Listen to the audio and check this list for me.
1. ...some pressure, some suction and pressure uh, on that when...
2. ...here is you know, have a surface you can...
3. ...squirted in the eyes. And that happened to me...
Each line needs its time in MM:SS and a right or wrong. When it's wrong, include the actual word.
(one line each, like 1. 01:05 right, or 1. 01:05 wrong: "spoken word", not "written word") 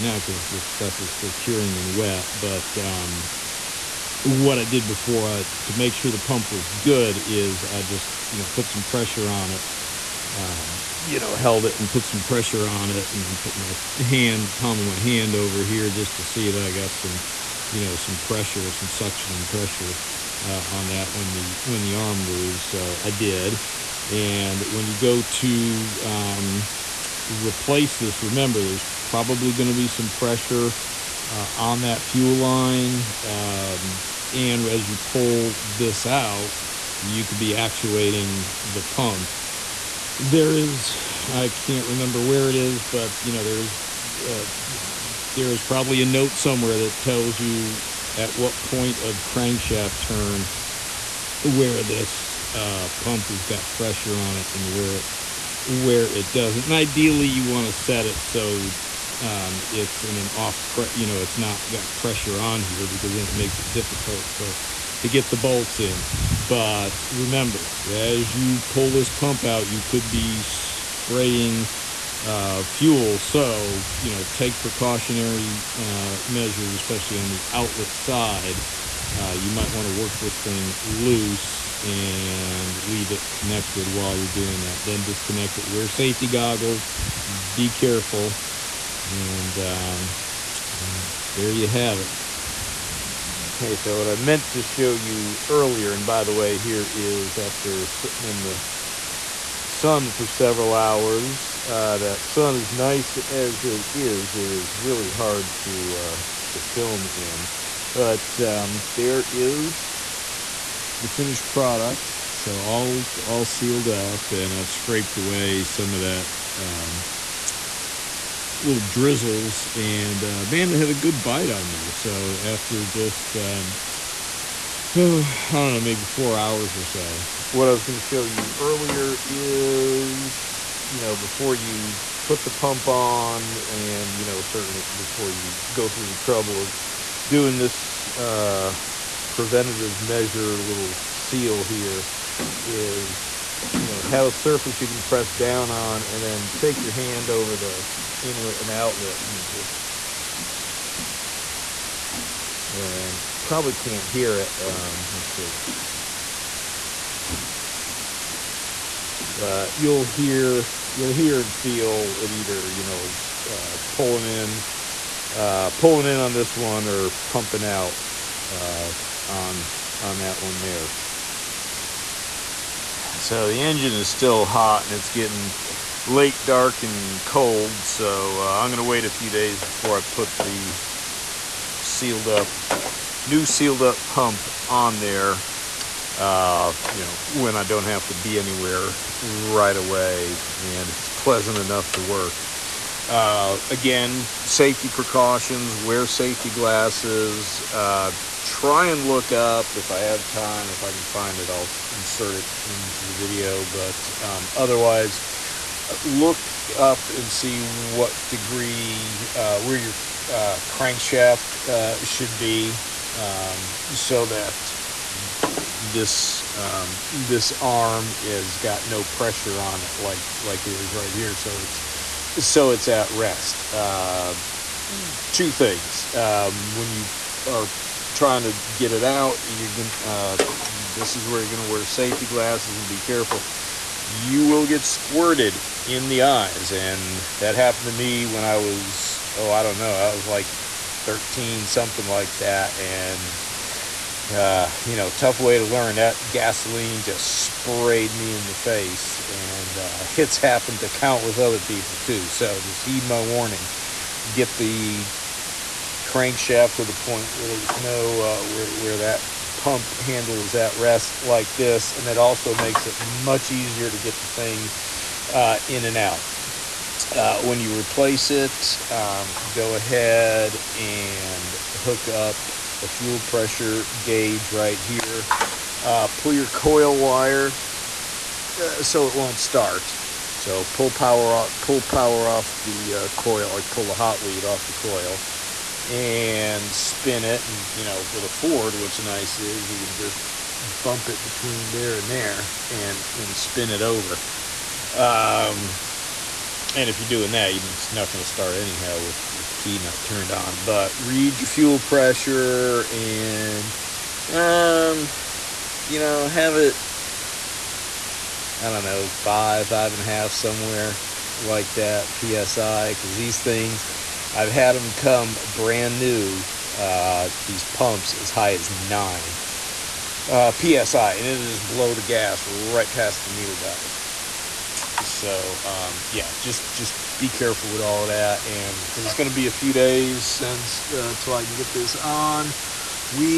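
1. 00:17 right
2. 02:21 right
3. 03:54 right.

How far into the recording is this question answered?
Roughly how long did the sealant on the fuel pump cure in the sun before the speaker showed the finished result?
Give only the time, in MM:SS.
02:06.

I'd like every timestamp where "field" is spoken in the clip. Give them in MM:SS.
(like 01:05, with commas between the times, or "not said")
not said.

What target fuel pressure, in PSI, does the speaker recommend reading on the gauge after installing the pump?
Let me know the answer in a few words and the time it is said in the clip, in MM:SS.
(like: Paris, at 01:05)
5 to 5.5, at 05:09.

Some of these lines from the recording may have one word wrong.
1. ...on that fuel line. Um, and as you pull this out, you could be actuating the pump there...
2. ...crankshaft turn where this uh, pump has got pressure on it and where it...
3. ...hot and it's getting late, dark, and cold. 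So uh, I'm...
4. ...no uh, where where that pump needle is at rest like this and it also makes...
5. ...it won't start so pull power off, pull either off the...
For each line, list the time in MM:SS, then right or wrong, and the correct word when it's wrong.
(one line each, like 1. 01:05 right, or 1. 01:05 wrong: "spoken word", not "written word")
1. 00:31 right
2. 00:49 right
3. 02:54 right
4. 04:17 wrong: "handle", not "needle"
5. 04:39 wrong: "power", not "either".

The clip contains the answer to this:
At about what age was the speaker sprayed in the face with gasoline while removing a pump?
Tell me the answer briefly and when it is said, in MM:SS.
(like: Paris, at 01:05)
13, at 04:01.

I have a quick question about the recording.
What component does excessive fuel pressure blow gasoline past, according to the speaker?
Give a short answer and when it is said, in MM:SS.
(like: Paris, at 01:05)
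needle valve, at 05:23.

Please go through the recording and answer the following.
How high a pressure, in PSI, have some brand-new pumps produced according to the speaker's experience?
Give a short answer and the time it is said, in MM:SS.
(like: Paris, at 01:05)
9, at 05:18.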